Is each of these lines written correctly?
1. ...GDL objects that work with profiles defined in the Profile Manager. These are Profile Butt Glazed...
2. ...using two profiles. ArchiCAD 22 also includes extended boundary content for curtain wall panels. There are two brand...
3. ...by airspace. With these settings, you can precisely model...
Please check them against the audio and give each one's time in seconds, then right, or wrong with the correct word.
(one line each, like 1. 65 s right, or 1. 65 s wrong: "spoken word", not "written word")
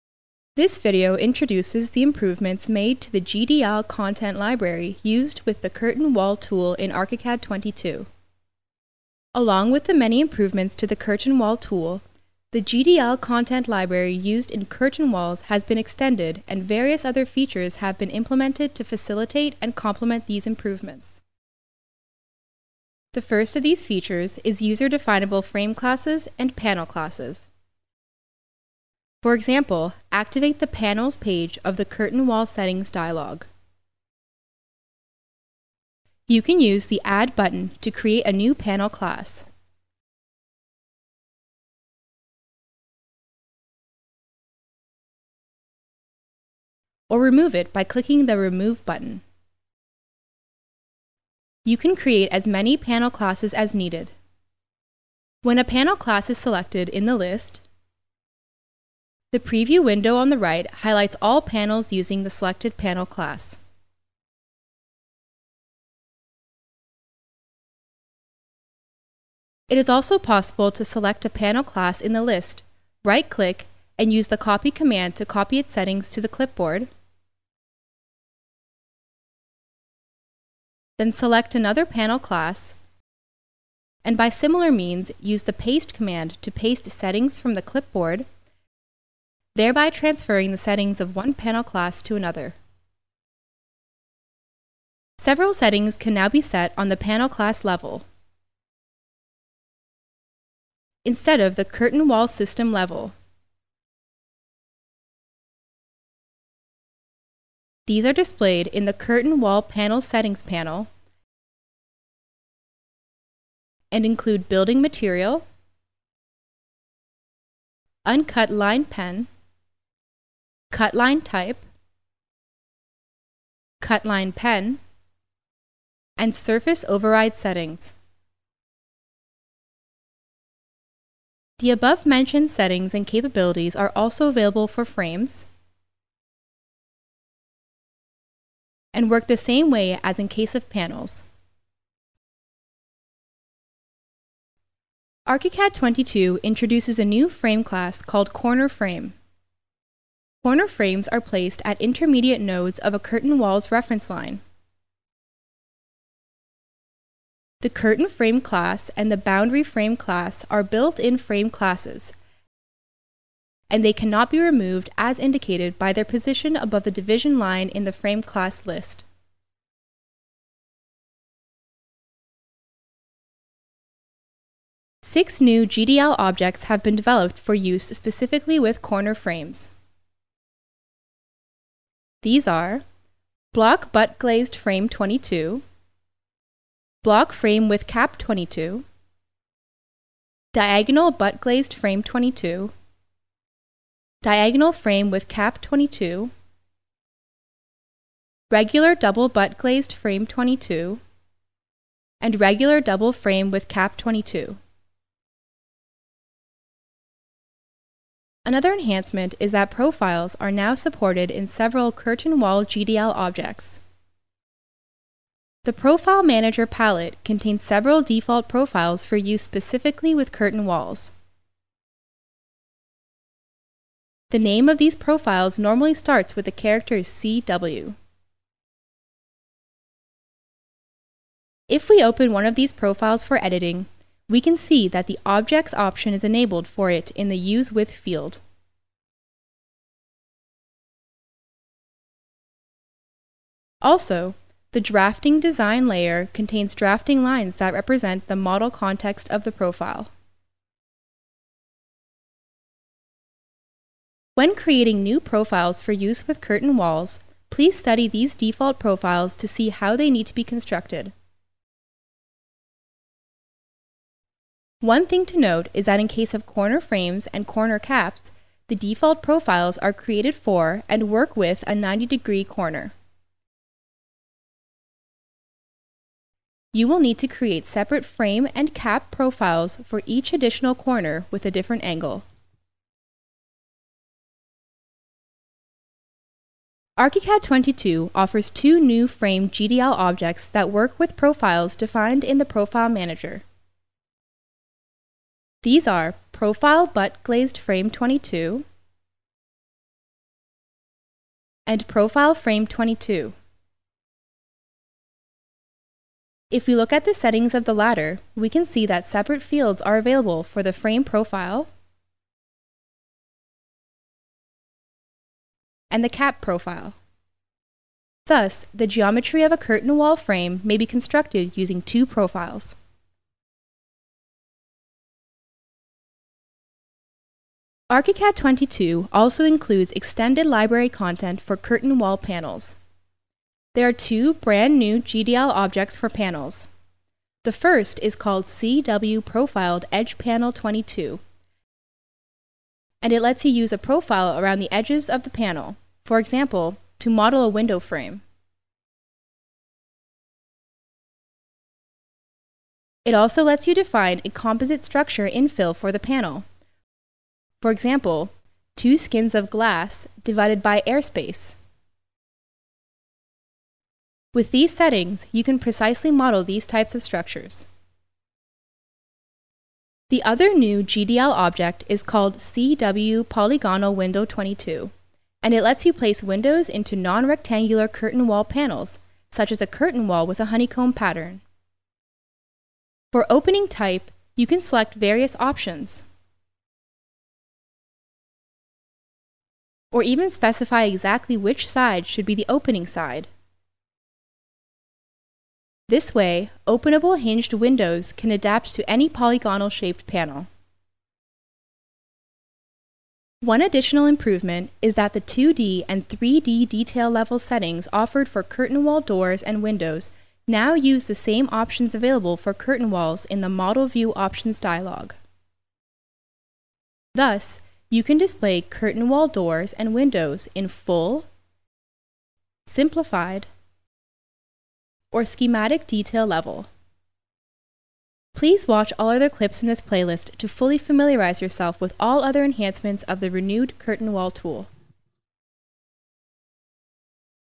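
1. 289 s right
2. 321 s wrong: "library", not "boundary"
3. 360 s right.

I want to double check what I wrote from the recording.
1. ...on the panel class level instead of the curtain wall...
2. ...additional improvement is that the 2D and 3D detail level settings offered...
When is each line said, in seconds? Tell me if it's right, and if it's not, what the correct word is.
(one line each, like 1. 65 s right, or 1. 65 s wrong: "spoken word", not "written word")
1. 96 s right
2. 403 s right.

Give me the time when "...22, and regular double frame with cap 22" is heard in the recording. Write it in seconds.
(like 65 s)
200 s.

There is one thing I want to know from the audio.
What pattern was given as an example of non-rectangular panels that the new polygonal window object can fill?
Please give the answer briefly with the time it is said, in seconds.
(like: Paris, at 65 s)
honeycomb, at 380 s.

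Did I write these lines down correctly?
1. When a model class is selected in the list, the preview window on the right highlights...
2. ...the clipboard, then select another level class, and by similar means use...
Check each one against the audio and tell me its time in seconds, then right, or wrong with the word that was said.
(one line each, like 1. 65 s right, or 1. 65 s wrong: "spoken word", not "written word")
1. 55 s wrong: "panel", not "model"
2. 76 s wrong: "panel", not "level".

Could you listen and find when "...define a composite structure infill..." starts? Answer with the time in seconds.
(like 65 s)
353 s.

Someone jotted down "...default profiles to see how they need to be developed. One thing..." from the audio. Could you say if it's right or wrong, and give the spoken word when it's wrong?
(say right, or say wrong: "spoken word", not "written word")
wrong: "constructed", not "developed".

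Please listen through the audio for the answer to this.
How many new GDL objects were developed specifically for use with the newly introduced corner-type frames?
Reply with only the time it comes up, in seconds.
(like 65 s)
175 s.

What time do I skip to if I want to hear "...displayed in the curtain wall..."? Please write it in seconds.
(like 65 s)
108 s.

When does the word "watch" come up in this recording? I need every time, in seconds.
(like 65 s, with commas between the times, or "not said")
428 s.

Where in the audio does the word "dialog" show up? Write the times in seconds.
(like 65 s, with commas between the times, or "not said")
32 s, 414 s.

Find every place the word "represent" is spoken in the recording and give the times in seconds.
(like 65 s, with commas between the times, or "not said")
247 s.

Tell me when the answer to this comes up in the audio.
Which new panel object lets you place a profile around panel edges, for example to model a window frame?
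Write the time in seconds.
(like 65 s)
338 s.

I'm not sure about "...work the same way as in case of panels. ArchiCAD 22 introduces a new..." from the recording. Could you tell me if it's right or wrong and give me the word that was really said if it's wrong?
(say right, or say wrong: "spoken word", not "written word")
right.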